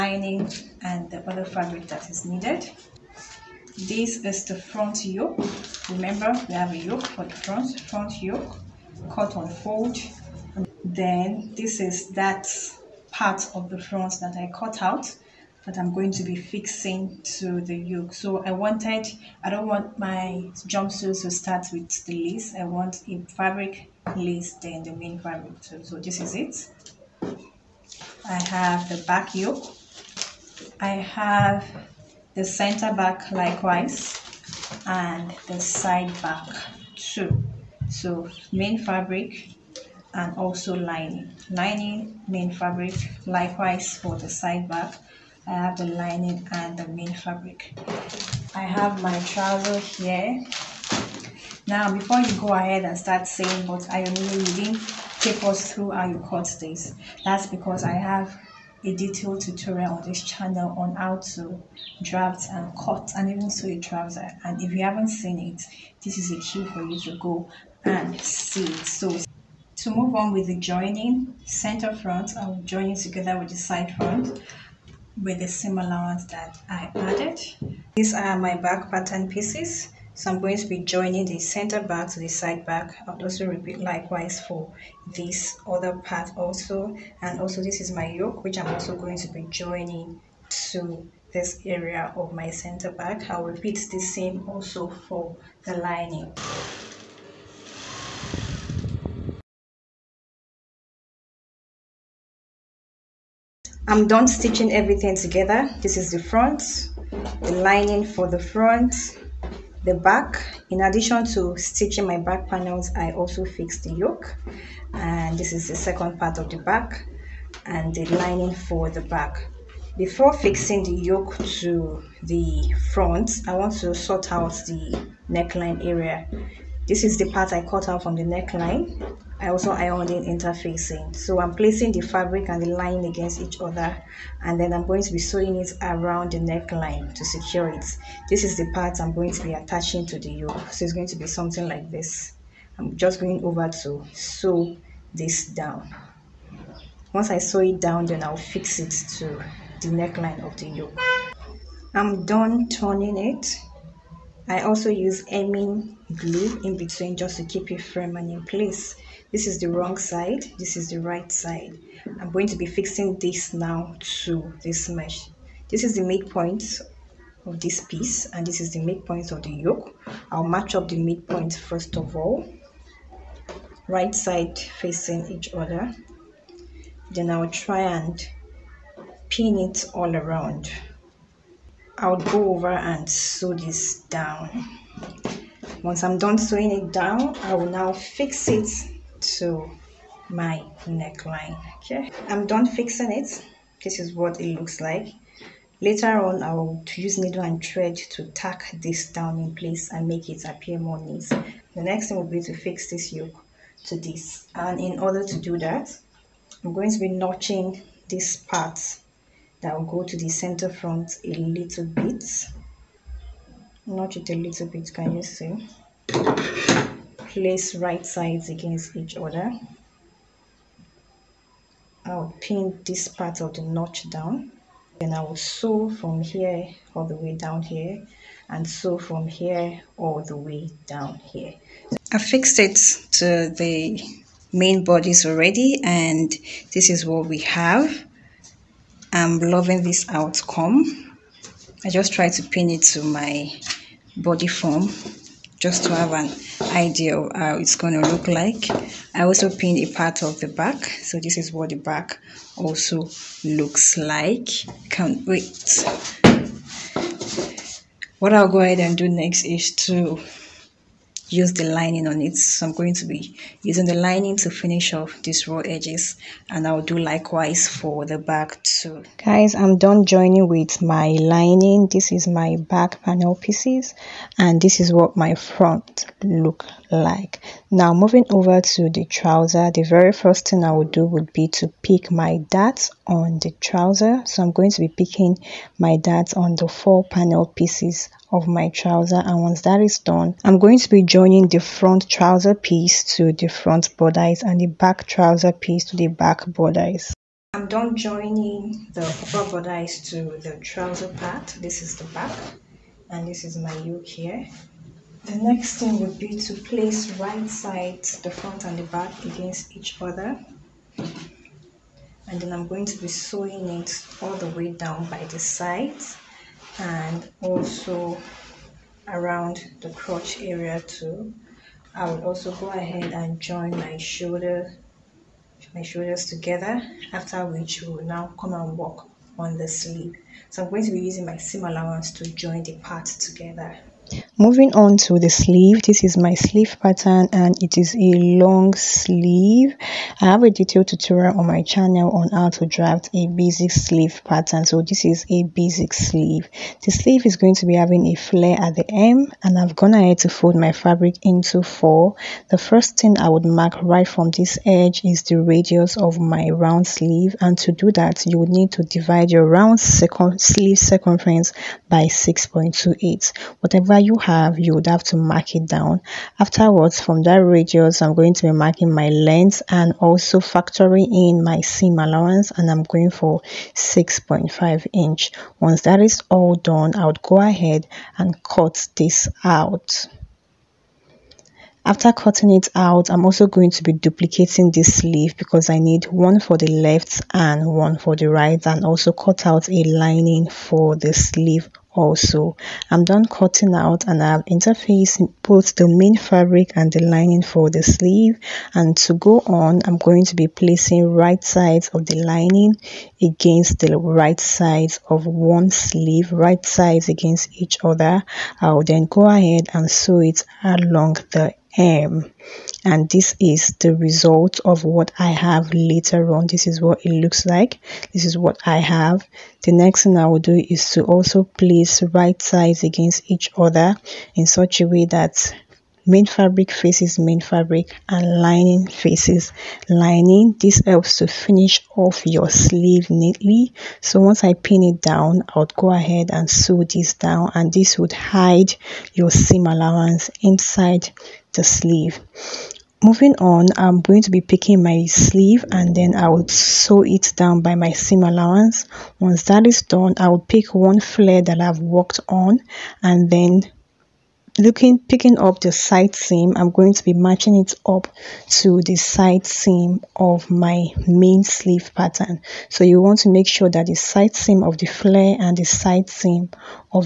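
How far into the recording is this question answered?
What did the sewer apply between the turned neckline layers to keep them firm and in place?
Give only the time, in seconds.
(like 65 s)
155 s.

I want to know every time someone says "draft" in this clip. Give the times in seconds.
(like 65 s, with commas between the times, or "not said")
62 s, 342 s.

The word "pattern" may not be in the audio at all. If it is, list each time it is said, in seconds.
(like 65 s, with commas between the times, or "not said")
78 s, 336 s, 344 s, 461 s.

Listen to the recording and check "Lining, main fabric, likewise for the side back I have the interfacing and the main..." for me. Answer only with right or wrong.
wrong.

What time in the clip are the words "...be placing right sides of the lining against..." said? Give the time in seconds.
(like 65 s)
400 s.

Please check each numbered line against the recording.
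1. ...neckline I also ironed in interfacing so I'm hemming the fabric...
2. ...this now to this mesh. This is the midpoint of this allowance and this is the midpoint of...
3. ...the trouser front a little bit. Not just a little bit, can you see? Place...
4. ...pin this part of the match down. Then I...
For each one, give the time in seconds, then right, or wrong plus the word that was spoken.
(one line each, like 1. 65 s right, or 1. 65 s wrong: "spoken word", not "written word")
1. 128 s wrong: "placing", not "hemming"
2. 163 s wrong: "piece", not "allowance"
3. 210 s wrong: "center", not "trouser"
4. 222 s wrong: "notch", not "match".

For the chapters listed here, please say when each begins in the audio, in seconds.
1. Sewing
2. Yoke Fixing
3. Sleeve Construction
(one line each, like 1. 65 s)
1. 96 s
2. 201 s
3. 334 s.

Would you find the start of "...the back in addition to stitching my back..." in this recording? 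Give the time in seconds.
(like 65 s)
109 s.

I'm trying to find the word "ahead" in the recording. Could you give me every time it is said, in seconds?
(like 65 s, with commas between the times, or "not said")
52 s, 258 s, 322 s, 349 s, 377 s, 409 s, 435 s.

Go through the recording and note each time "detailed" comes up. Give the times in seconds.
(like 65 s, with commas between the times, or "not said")
58 s, 340 s.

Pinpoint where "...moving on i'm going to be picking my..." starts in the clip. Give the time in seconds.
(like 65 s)
443 s.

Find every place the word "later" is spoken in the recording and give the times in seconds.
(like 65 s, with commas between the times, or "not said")
195 s, 415 s.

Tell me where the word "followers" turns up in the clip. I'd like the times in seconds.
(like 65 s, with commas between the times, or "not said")
not said.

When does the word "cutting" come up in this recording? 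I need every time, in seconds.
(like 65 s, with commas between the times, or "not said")
382 s, 393 s.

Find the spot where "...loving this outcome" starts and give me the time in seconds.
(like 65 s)
239 s.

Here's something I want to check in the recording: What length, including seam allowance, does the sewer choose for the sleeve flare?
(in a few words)
6.5 inch.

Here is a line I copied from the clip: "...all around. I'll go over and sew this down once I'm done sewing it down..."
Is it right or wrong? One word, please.
right.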